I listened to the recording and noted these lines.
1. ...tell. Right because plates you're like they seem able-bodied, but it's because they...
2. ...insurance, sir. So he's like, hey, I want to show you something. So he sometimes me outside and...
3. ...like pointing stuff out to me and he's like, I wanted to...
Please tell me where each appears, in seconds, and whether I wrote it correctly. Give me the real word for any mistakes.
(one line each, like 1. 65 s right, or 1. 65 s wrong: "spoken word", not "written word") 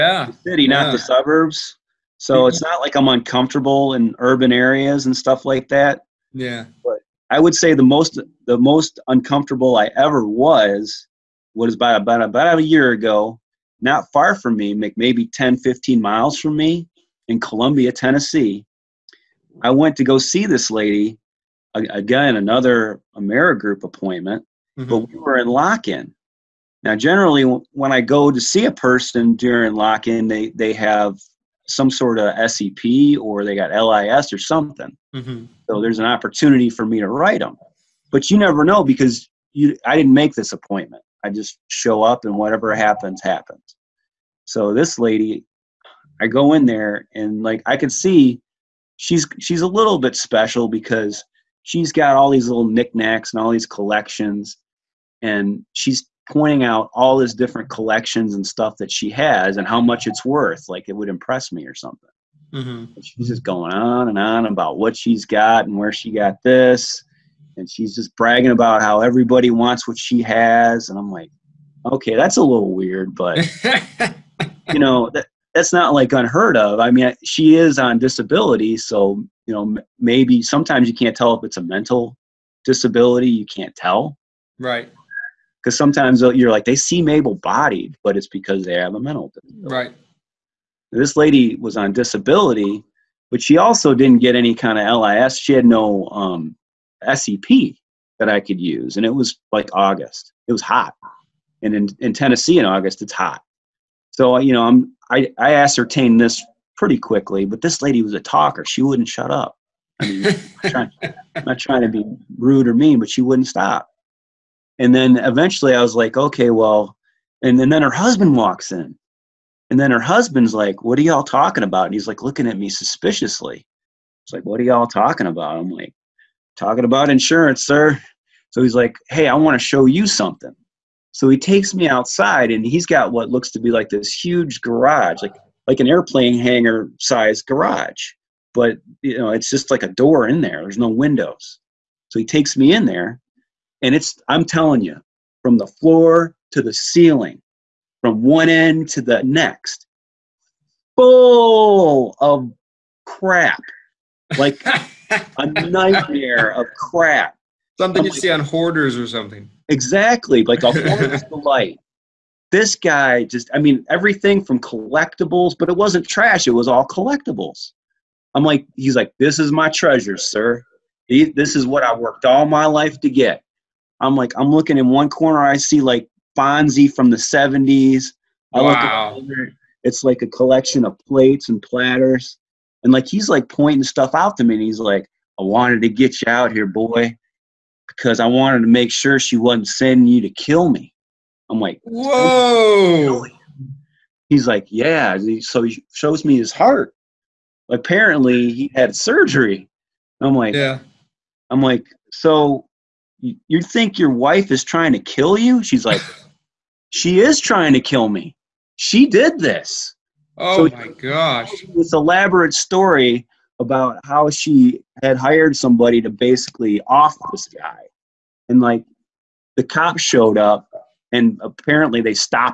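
1. 83 s wrong: "sometimes", not "plates"
2. 127 s wrong: "takes", not "sometimes"
3. 183 s right.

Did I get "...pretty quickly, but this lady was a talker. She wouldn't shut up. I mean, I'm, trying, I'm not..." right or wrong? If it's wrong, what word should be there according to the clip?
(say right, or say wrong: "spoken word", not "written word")
right.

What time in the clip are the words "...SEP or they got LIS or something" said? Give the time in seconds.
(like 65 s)
32 s.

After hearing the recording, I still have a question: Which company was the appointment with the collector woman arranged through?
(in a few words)
AmeriGroup.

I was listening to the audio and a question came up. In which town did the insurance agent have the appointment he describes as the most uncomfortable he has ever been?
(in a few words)
Columbia, Tennessee.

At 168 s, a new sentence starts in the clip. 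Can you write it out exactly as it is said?
I'm like, he's like, this is my treasure, sir.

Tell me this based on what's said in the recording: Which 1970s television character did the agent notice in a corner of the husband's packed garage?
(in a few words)
Fonzie.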